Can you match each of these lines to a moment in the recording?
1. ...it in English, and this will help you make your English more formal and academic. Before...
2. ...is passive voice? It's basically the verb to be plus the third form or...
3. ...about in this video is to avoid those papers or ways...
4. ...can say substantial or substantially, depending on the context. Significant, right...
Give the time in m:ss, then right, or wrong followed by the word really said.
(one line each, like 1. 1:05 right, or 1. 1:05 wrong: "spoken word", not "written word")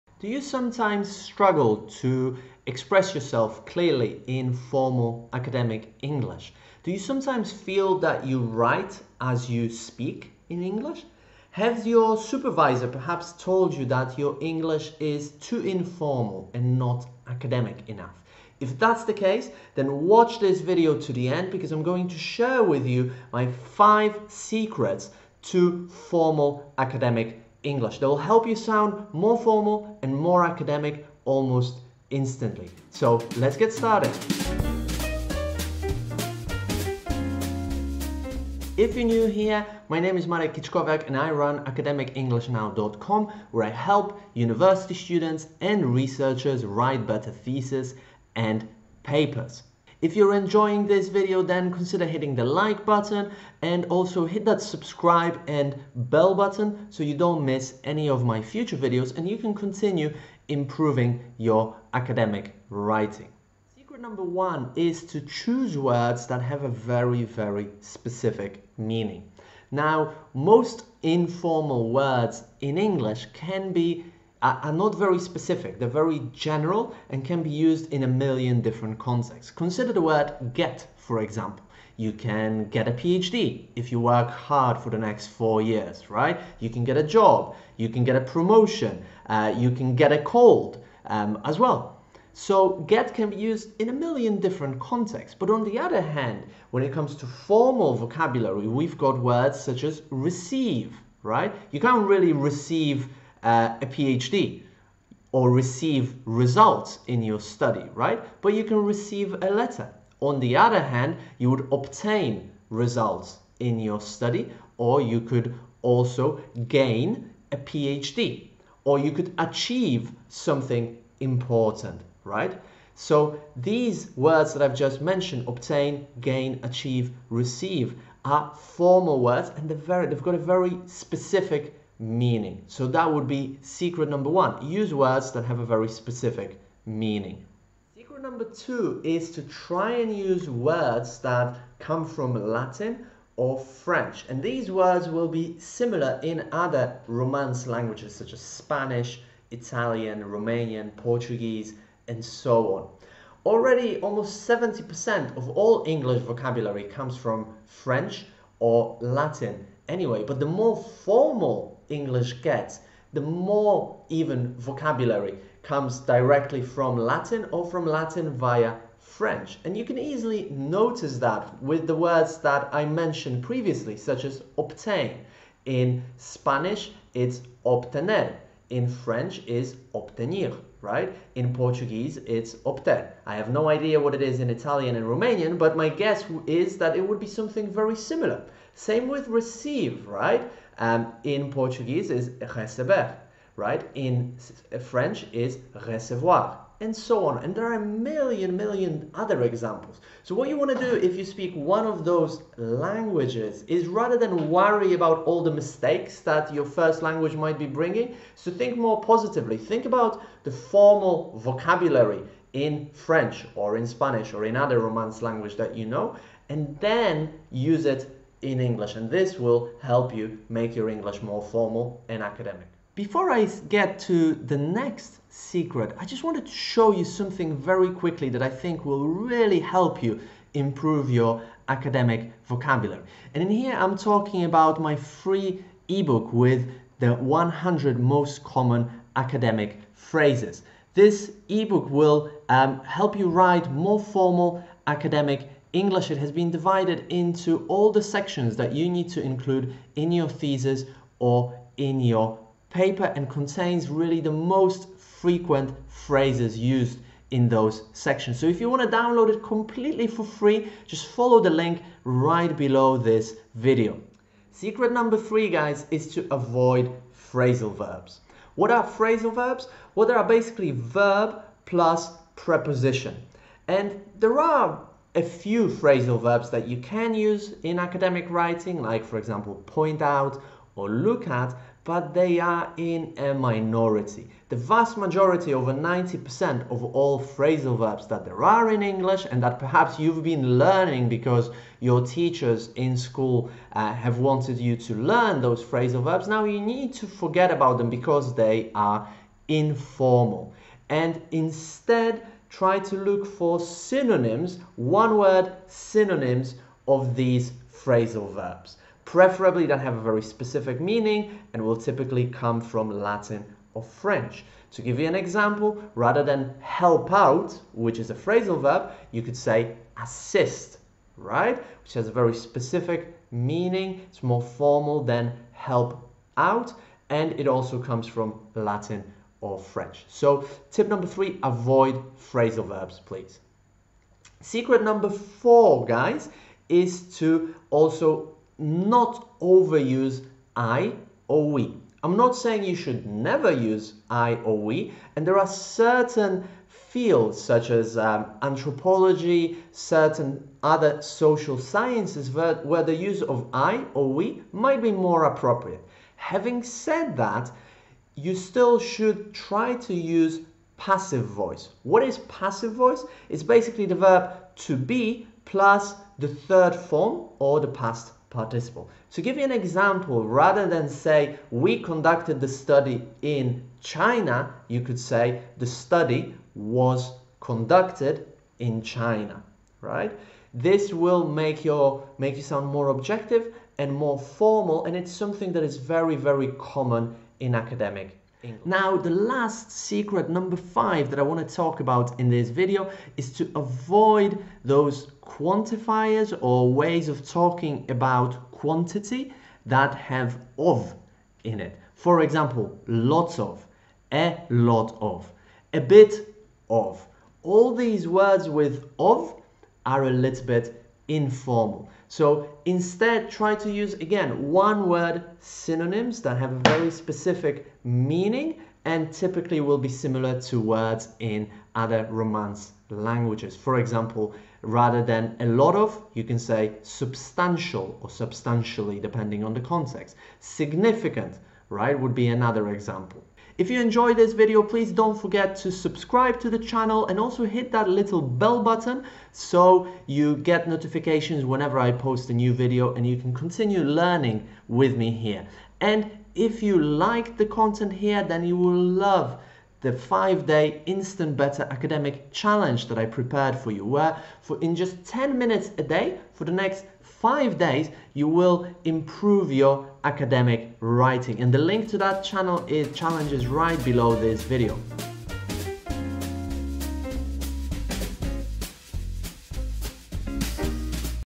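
1. 3:37 right
2. 6:02 right
3. 6:31 wrong: "quantifiers", not "papers"
4. 7:06 right.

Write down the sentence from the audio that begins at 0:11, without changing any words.
Has your supervisor perhaps told you that your English is too informal and not academic enough?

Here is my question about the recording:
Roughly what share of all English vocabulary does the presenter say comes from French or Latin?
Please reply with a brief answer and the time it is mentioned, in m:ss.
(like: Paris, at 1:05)
70%, at 2:34.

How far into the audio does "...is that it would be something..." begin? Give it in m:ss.
3:06.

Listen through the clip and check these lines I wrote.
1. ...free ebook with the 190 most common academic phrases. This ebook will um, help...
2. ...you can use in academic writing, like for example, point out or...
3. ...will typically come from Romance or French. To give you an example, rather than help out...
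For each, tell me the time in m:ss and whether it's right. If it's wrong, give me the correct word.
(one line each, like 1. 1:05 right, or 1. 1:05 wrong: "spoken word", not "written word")
1. 3:54 wrong: "100", not "190"
2. 4:36 right
3. 5:11 wrong: "Latin", not "Romance".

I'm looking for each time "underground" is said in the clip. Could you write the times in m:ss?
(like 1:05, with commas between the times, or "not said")
not said.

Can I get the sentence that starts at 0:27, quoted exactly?
They will help you sound more formal and more academic almost instantly.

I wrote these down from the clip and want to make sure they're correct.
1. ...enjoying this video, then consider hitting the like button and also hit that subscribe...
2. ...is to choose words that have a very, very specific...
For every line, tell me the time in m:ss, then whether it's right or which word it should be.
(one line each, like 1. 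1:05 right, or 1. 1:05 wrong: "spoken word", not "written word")
1. 0:50 right
2. 1:04 right.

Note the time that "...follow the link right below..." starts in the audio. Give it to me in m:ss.
4:21.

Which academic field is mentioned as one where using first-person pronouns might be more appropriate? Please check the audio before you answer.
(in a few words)
anthropology.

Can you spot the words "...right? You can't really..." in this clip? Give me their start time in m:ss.
1:41.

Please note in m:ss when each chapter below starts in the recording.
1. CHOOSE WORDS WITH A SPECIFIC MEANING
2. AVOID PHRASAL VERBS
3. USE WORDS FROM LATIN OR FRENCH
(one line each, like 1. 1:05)
1. 1:07
2. 4:30
3. 2:25.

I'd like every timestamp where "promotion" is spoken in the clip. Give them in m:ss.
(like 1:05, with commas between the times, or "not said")
1:28.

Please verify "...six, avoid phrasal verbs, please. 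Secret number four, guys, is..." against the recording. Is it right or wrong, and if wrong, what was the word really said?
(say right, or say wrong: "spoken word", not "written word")
wrong: "three", not "six".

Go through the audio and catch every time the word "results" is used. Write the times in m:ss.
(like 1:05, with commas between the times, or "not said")
1:46, 1:52.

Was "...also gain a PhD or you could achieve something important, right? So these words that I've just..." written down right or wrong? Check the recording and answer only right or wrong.
right.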